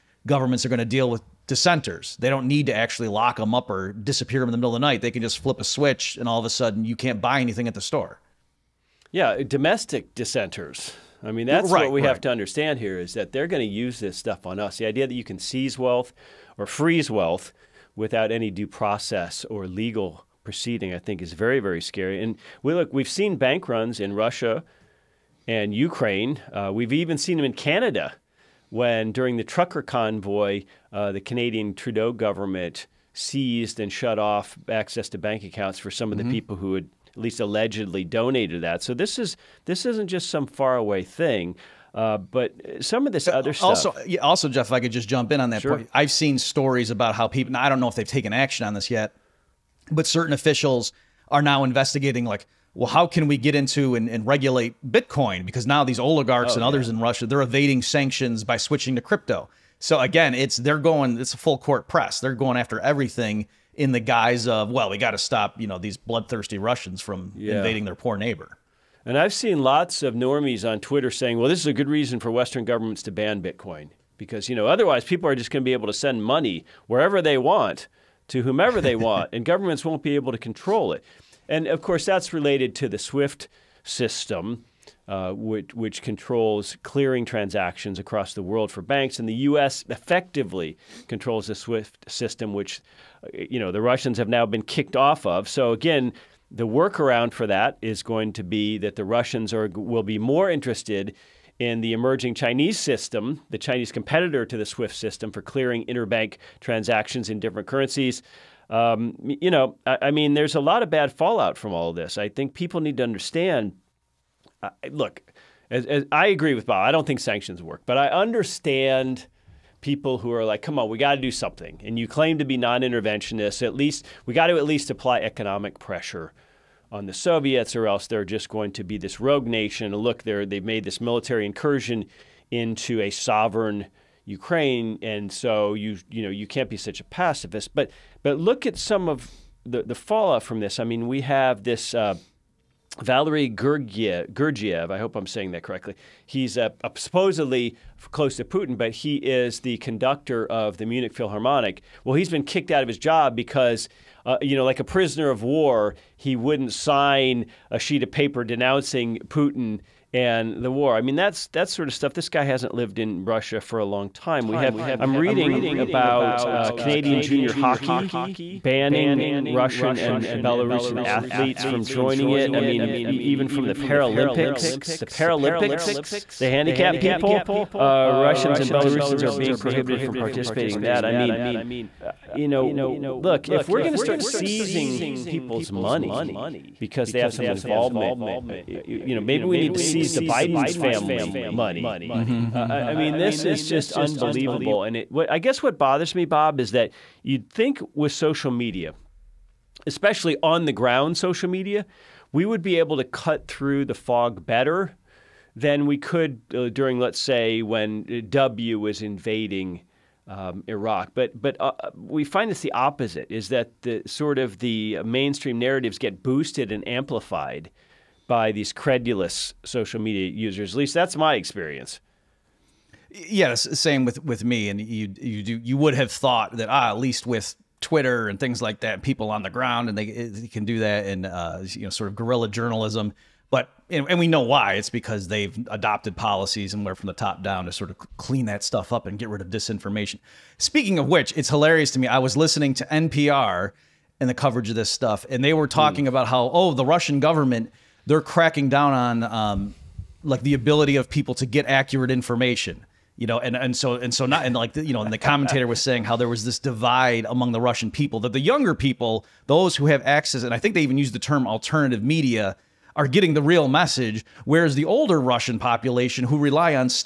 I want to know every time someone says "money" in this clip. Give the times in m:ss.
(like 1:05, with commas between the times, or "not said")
1:16, 3:05, 3:11.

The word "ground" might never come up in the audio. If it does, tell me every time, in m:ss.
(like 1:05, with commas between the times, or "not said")
3:20, 3:49.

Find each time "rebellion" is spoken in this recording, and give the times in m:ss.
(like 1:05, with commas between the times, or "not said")
not said.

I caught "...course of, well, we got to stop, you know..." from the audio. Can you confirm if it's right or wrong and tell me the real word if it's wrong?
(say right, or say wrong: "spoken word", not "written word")
wrong: "guise", not "course".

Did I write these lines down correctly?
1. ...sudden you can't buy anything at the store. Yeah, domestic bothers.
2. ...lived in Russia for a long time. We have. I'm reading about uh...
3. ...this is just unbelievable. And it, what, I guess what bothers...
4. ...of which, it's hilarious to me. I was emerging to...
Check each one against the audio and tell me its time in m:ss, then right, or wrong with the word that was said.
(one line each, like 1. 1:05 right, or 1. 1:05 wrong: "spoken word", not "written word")
1. 0:06 wrong: "dissenters", not "bothers"
2. 2:42 right
3. 3:13 right
4. 4:00 wrong: "listening", not "emerging".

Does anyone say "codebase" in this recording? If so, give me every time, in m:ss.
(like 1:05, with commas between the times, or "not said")
not said.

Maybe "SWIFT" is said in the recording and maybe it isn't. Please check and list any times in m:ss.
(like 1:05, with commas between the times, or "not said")
1:22, 1:31, 1:44.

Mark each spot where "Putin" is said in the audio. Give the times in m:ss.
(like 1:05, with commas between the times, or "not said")
2:28, 2:39.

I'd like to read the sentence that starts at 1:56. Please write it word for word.
I don't think sanctions work, but I understand people who are like, come on, we got to do something.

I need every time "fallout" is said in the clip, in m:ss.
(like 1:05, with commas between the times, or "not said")
1:51, 2:19.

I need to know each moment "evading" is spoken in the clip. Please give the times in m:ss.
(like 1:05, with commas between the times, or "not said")
0:57.